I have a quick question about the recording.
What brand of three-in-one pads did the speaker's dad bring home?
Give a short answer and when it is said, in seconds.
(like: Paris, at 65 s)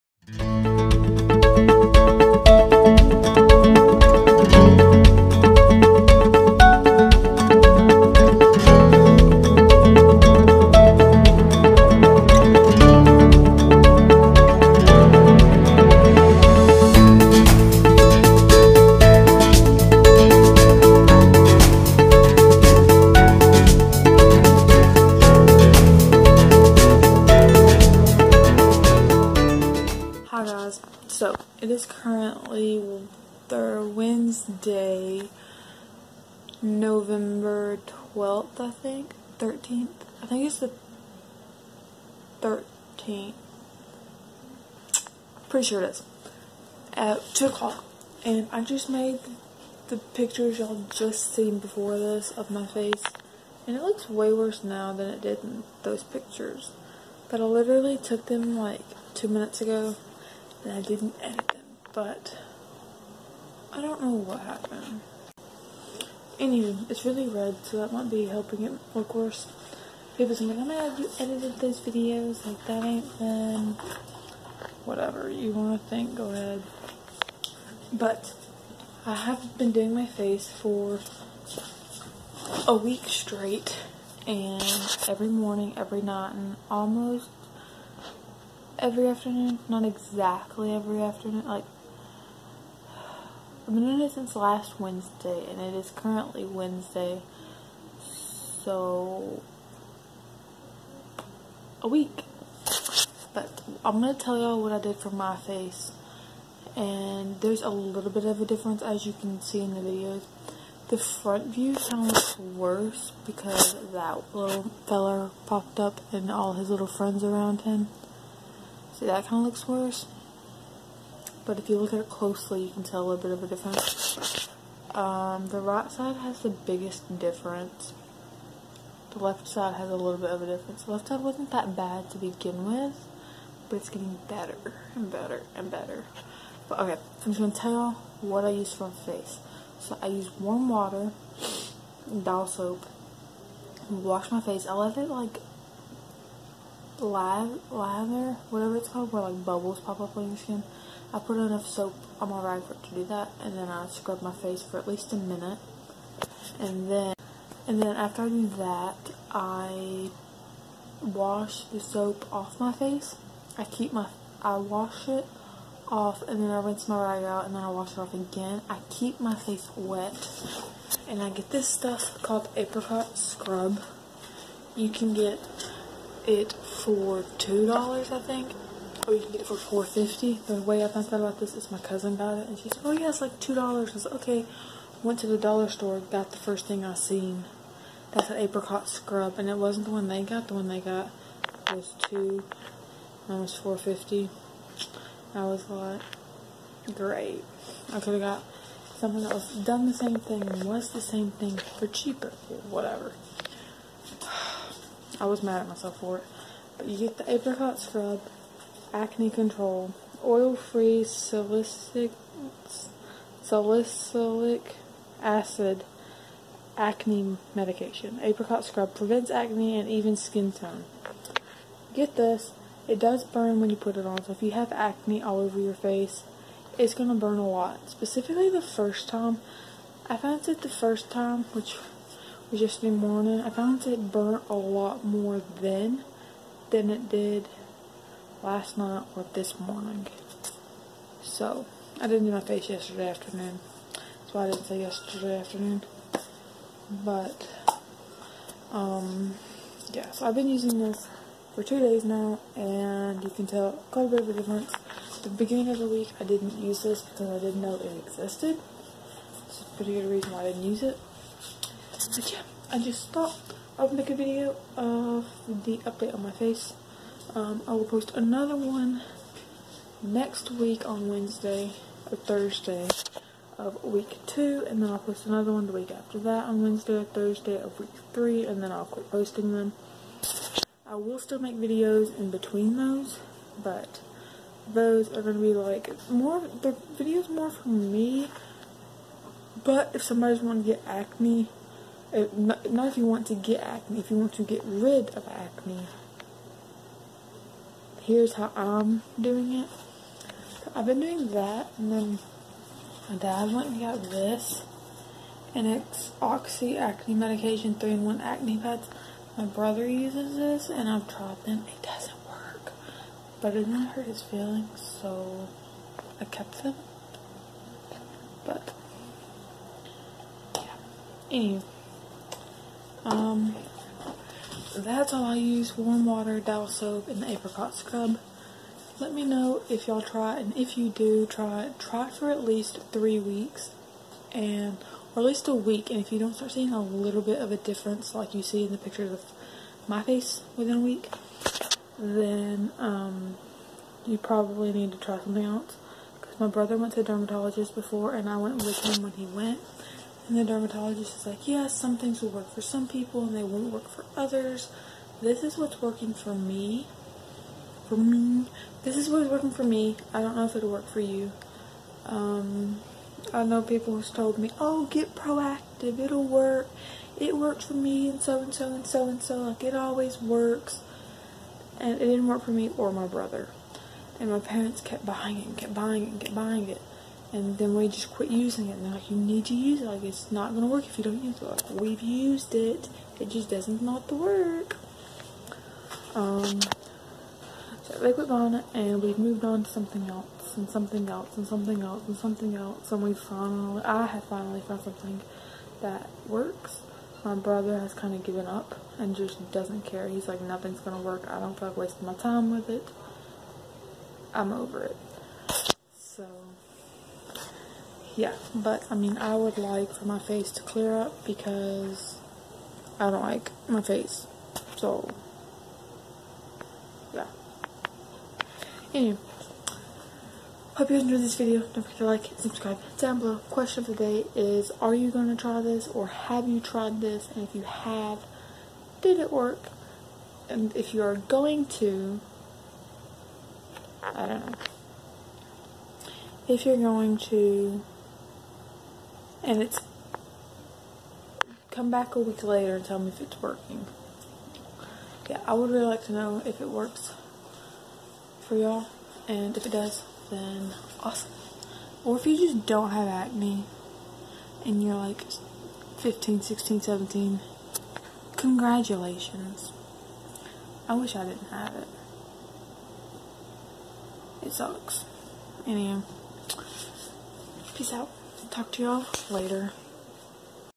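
Oxy, at 306 s.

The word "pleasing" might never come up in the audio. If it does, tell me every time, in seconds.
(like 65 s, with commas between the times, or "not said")
not said.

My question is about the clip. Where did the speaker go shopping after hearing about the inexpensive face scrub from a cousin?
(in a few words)
The dollar store.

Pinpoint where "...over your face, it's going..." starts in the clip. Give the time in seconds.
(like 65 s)
225 s.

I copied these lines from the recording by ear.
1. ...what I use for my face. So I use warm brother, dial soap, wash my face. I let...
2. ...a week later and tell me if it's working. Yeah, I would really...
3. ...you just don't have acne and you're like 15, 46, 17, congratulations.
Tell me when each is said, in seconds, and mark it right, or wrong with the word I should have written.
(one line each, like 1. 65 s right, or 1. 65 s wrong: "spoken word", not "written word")
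1. 138 s wrong: "water", not "brother"
2. 442 s right
3. 452 s wrong: "16", not "46".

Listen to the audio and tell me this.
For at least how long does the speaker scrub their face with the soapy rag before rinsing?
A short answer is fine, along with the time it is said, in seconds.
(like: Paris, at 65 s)
A minute, at 155 s.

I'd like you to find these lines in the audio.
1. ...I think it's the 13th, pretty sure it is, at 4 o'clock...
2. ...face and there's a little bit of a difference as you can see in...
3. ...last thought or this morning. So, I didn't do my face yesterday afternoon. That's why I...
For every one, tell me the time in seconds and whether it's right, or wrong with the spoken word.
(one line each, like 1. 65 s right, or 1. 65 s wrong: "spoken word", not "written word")
1. 40 s wrong: "2", not "4"
2. 105 s right
3. 238 s wrong: "night", not "thought".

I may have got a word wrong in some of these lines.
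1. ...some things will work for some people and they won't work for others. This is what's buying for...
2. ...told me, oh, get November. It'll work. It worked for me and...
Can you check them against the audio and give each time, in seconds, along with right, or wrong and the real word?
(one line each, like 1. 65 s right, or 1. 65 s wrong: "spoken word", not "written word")
1. 351 s wrong: "working", not "buying"
2. 364 s wrong: "Proactiv", not "November".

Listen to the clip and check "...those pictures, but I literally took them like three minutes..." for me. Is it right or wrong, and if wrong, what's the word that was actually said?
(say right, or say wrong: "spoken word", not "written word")
wrong: "two", not "three".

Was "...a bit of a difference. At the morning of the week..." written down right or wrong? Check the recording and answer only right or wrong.
wrong.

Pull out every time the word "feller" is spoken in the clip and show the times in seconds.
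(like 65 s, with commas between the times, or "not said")
114 s.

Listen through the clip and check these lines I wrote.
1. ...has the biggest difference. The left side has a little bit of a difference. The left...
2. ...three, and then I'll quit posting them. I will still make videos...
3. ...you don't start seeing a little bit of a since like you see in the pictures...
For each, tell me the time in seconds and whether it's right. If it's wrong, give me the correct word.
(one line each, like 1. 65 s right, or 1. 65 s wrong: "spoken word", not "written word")
1. 126 s right
2. 278 s right
3. 336 s wrong: "difference", not "since".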